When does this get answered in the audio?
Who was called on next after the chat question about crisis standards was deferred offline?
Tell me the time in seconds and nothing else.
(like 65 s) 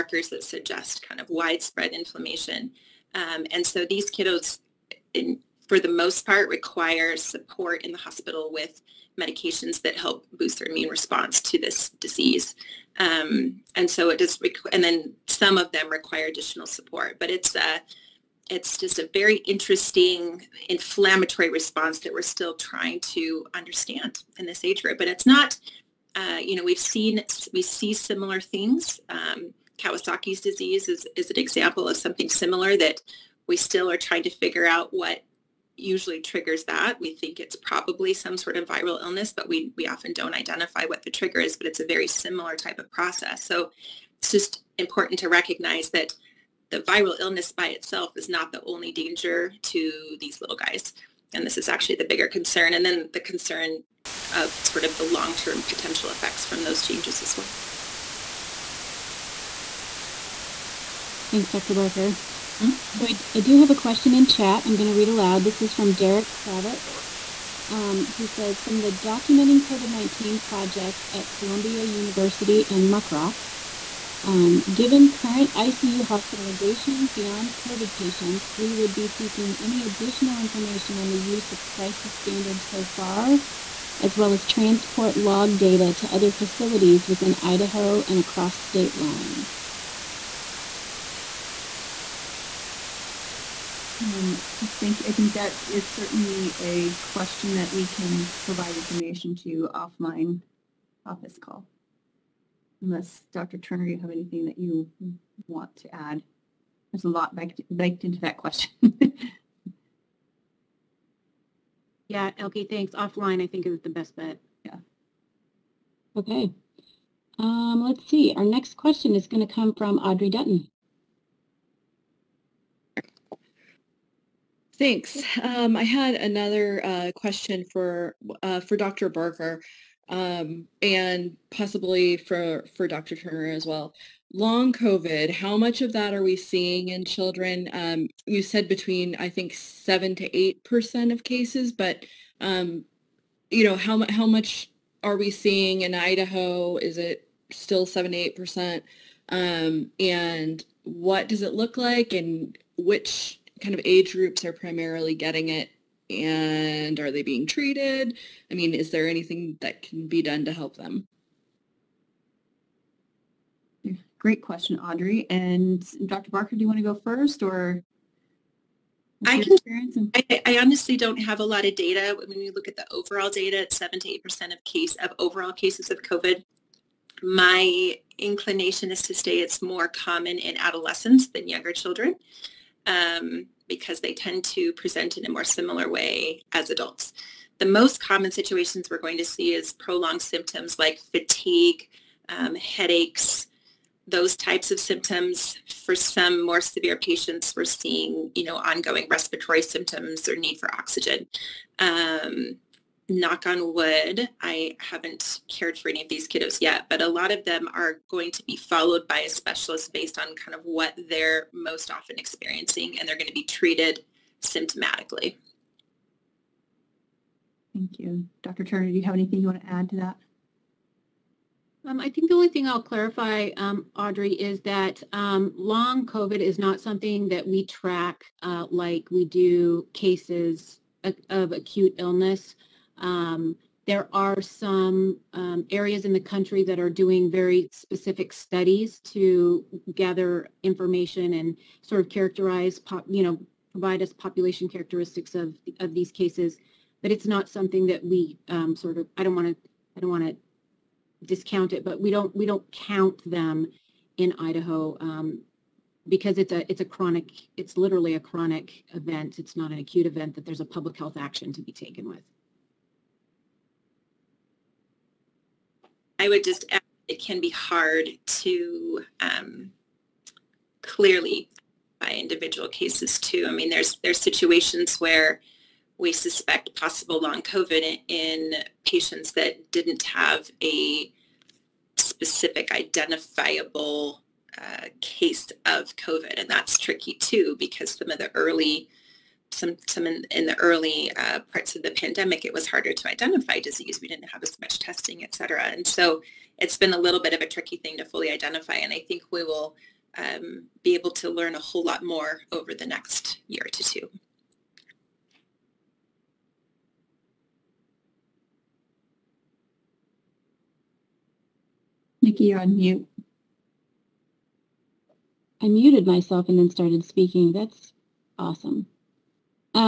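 119 s.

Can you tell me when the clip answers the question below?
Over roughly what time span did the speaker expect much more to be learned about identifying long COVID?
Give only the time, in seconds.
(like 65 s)
302 s.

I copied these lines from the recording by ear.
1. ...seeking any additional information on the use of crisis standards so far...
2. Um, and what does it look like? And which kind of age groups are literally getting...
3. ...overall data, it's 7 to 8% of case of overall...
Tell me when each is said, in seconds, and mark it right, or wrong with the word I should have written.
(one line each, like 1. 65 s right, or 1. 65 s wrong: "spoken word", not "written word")
1. 79 s right
2. 149 s wrong: "primarily", not "literally"
3. 172 s right.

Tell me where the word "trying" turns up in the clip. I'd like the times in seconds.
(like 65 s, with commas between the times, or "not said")
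22 s, 33 s.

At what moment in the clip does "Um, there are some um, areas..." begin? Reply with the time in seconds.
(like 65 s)
232 s.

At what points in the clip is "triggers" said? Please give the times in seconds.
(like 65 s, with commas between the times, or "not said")
36 s, 41 s.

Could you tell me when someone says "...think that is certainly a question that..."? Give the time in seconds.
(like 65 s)
95 s.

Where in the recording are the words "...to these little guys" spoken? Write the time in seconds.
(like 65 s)
49 s.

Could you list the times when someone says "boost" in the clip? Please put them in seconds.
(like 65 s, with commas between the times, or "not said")
10 s.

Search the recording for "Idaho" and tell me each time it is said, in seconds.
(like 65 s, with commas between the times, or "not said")
87 s, 145 s, 254 s.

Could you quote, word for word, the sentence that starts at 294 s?
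We didn't have as much testing, et cetera.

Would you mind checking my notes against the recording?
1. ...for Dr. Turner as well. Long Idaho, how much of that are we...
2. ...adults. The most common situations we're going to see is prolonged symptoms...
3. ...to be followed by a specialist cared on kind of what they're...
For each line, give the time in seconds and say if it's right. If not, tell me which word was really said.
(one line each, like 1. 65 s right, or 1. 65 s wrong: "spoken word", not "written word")
1. 132 s wrong: "COVID", not "Idaho"
2. 186 s right
3. 208 s wrong: "based", not "cared".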